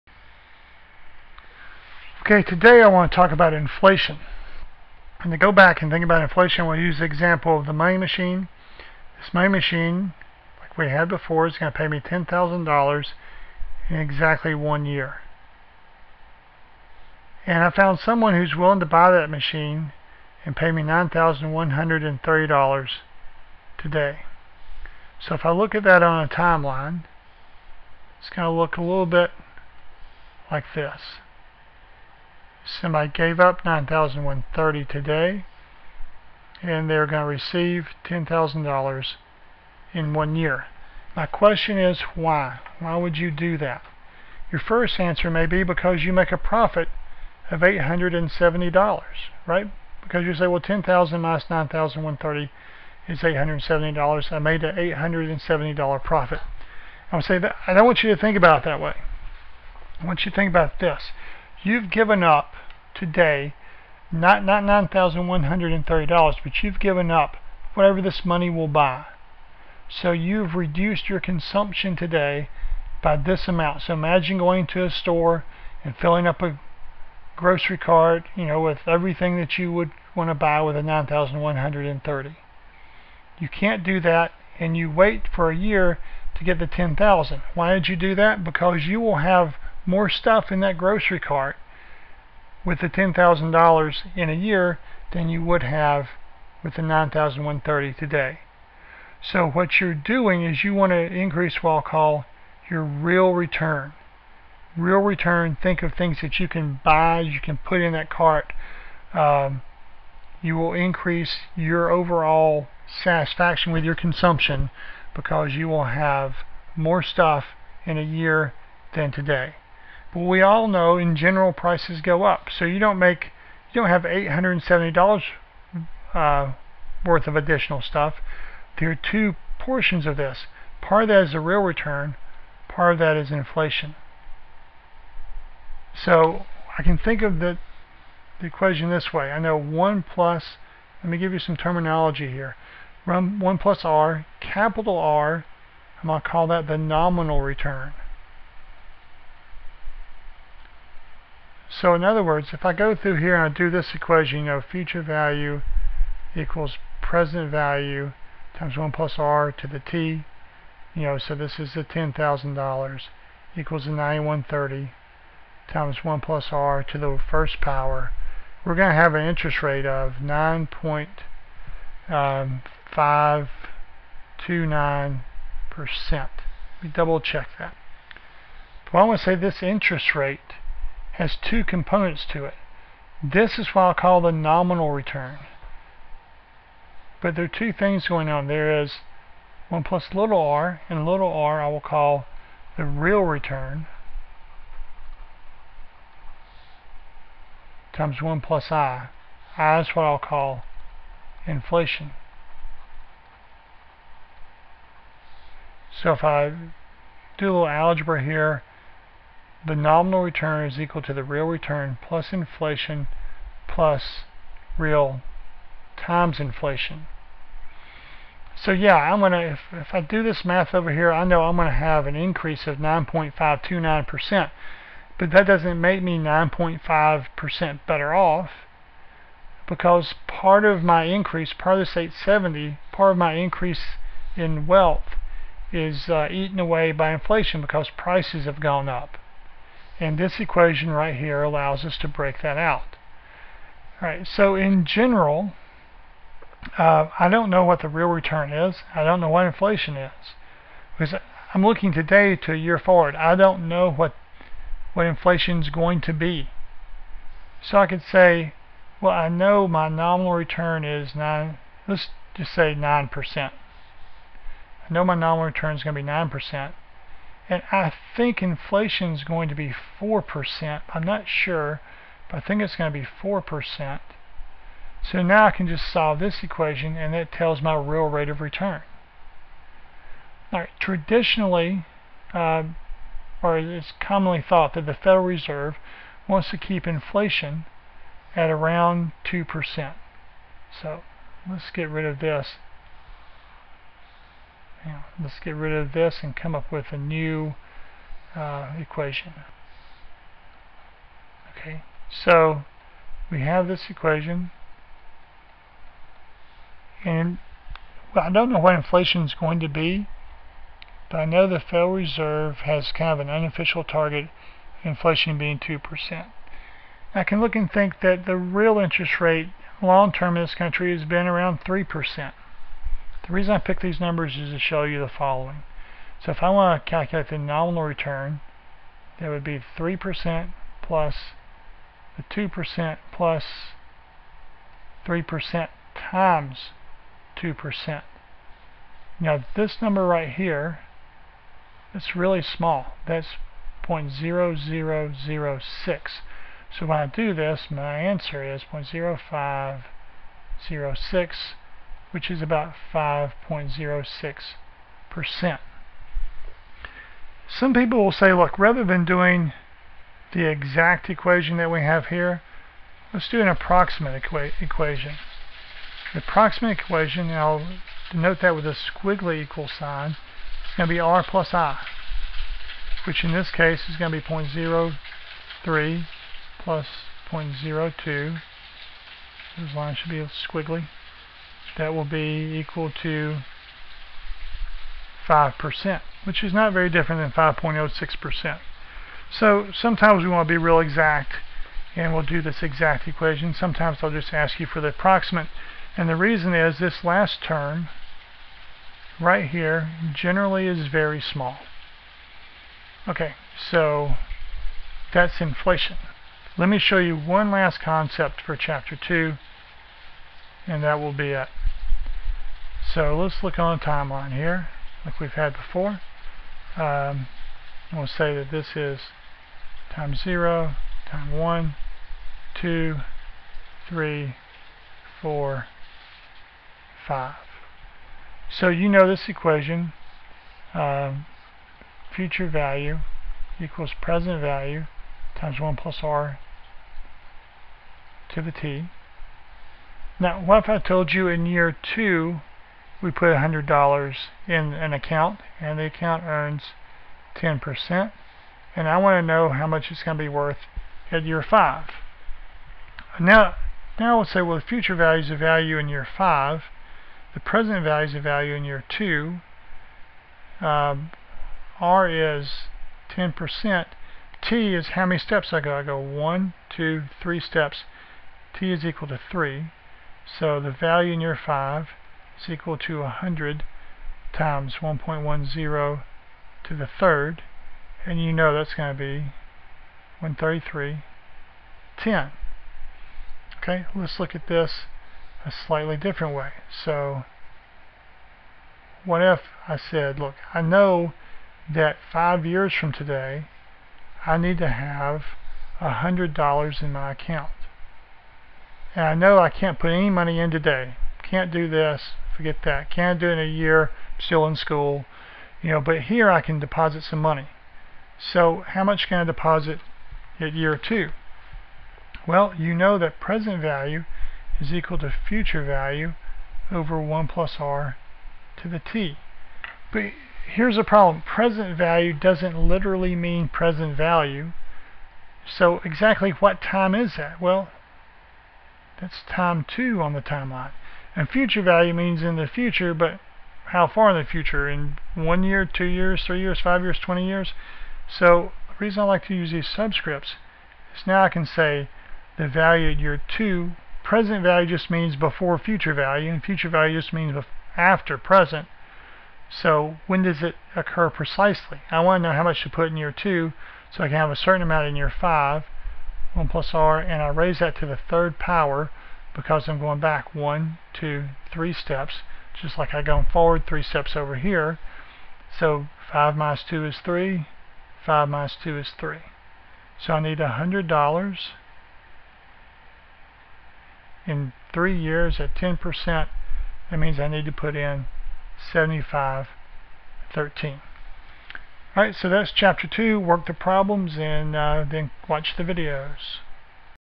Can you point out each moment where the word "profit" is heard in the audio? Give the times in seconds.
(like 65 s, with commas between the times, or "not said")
46 s, 56 s.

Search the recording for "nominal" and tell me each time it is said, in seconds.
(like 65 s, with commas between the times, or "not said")
146 s, 184 s, 209 s, 259 s, 265 s, 327 s.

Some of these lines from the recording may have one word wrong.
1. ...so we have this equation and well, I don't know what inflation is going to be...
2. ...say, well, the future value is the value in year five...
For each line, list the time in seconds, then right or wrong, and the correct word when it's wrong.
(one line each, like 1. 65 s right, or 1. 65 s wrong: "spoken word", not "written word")
1. 302 s right
2. 454 s right.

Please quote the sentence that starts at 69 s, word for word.
So you've reduced your consumption today by this amount.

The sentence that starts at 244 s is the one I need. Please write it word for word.
All right, so in general, uh, I don't know what the real return is.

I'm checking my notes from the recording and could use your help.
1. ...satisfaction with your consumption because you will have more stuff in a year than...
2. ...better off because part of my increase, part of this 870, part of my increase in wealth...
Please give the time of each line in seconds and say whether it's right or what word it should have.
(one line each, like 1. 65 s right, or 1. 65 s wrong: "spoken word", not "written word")
1. 113 s right
2. 227 s right.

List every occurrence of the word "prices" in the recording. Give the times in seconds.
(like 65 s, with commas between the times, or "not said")
121 s, 237 s.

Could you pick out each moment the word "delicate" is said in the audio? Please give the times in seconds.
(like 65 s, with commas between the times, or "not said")
not said.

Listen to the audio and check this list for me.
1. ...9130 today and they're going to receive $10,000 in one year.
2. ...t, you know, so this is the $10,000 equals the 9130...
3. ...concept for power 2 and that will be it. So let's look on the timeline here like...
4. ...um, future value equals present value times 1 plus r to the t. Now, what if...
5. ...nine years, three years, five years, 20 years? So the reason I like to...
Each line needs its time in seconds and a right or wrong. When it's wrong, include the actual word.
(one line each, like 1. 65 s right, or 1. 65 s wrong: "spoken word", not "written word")
1. 33 s right
2. 159 s right
3. 407 s wrong: "chapter", not "power"
4. 430 s right
5. 535 s wrong: "two", not "nine".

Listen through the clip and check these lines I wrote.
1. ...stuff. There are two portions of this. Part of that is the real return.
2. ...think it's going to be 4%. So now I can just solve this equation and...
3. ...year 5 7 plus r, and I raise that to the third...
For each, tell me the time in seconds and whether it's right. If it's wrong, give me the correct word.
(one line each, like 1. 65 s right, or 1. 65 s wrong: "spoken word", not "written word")
1. 127 s right
2. 272 s right
3. 554 s wrong: "1", not "7".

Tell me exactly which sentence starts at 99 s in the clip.
So what you're doing is you want to increase what I'll call your real return.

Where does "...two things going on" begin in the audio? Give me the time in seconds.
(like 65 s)
187 s.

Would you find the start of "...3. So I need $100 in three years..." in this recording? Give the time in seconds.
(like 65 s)
568 s.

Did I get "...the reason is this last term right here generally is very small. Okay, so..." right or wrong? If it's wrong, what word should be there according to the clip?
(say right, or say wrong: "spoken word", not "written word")
right.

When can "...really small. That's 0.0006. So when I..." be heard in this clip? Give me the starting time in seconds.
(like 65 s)
342 s.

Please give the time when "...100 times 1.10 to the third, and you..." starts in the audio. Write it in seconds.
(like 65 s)
473 s.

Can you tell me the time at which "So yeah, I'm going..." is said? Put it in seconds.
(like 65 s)
218 s.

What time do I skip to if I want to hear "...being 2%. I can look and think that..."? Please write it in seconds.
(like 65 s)
315 s.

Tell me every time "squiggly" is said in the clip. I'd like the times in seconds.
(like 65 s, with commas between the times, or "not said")
368 s, 380 s.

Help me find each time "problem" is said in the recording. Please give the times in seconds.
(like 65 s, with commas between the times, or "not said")
520 s, 583 s.